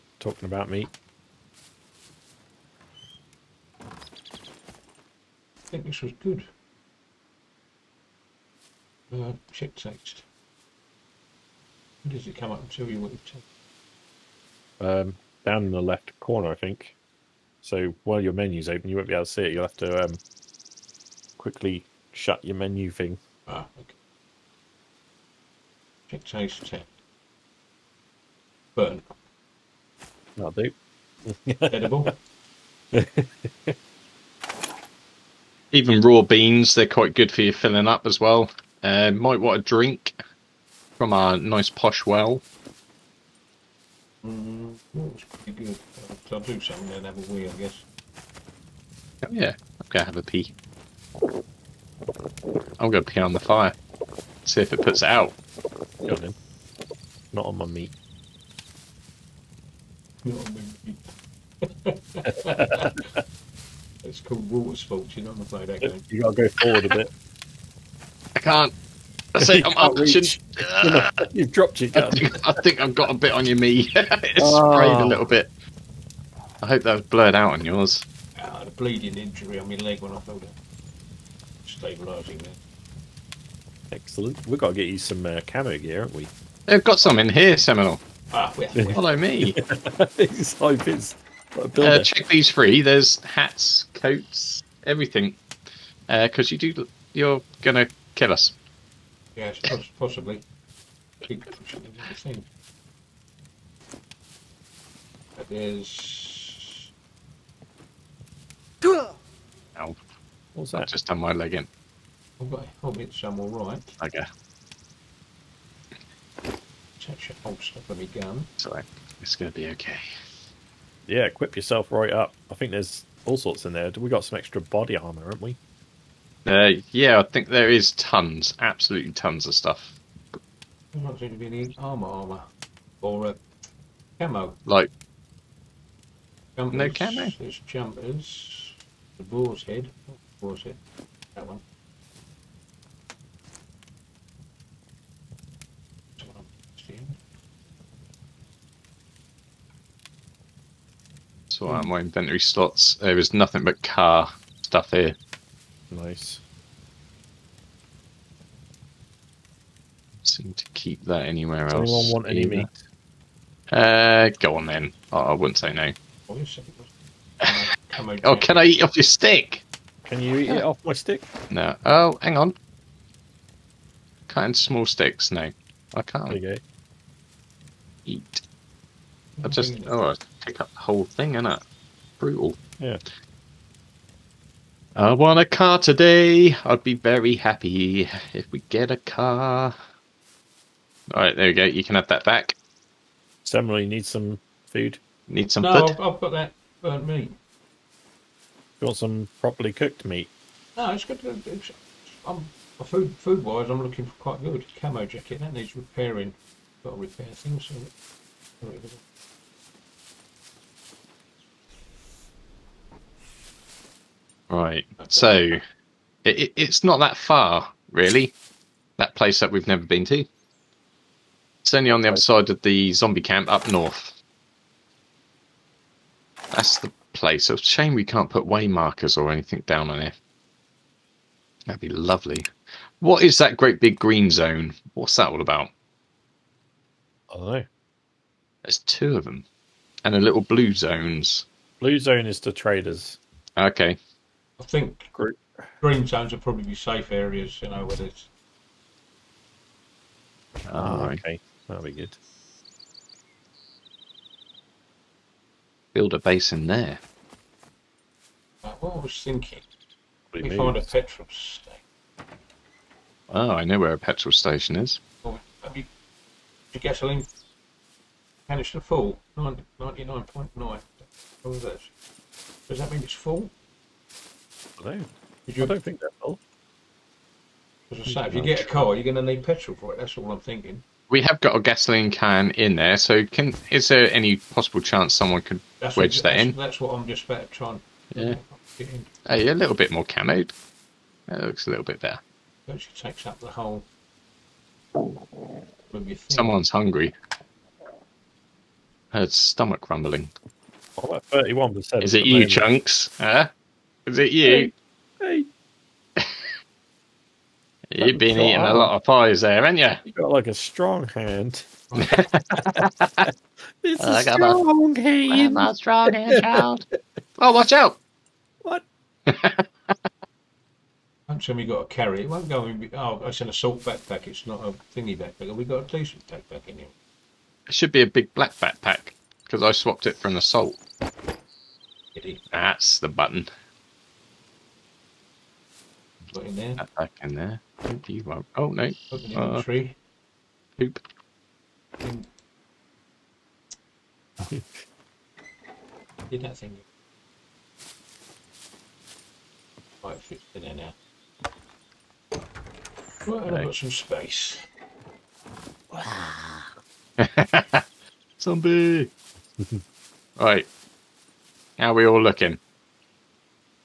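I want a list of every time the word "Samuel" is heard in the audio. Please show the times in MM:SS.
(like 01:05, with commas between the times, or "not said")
03:13.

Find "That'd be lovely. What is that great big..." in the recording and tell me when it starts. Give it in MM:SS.
03:51.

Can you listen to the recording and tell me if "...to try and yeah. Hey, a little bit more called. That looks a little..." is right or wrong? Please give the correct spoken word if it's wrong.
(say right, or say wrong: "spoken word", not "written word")
wrong: "camoed", not "called".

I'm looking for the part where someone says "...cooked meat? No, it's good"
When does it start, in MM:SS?
03:19.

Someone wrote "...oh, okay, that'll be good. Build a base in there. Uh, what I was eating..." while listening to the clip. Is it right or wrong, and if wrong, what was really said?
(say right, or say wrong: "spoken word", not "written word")
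wrong: "thinking", not "eating".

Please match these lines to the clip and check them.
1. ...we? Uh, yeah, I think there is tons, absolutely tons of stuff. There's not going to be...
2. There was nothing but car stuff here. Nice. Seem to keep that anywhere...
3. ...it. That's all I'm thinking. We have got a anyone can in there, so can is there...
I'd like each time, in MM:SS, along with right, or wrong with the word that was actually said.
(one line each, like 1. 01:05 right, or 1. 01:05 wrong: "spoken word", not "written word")
1. 02:05 right
2. 02:32 right
3. 04:39 wrong: "gasoline", not "anyone".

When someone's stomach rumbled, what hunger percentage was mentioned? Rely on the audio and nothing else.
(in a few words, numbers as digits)
31%.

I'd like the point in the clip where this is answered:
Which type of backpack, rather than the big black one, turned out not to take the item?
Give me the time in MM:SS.
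05:23.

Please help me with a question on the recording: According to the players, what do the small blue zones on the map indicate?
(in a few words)
The traders.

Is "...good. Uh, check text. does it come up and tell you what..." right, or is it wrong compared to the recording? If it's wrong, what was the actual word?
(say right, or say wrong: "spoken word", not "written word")
right.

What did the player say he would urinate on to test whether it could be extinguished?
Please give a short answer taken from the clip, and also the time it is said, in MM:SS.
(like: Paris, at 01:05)
The fire, at 00:53.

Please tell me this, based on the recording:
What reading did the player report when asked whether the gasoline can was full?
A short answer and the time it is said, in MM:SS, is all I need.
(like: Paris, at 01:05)
99.9, at 04:29.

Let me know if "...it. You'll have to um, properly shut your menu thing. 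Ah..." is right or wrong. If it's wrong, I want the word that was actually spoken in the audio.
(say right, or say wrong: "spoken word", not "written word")
wrong: "quickly", not "properly".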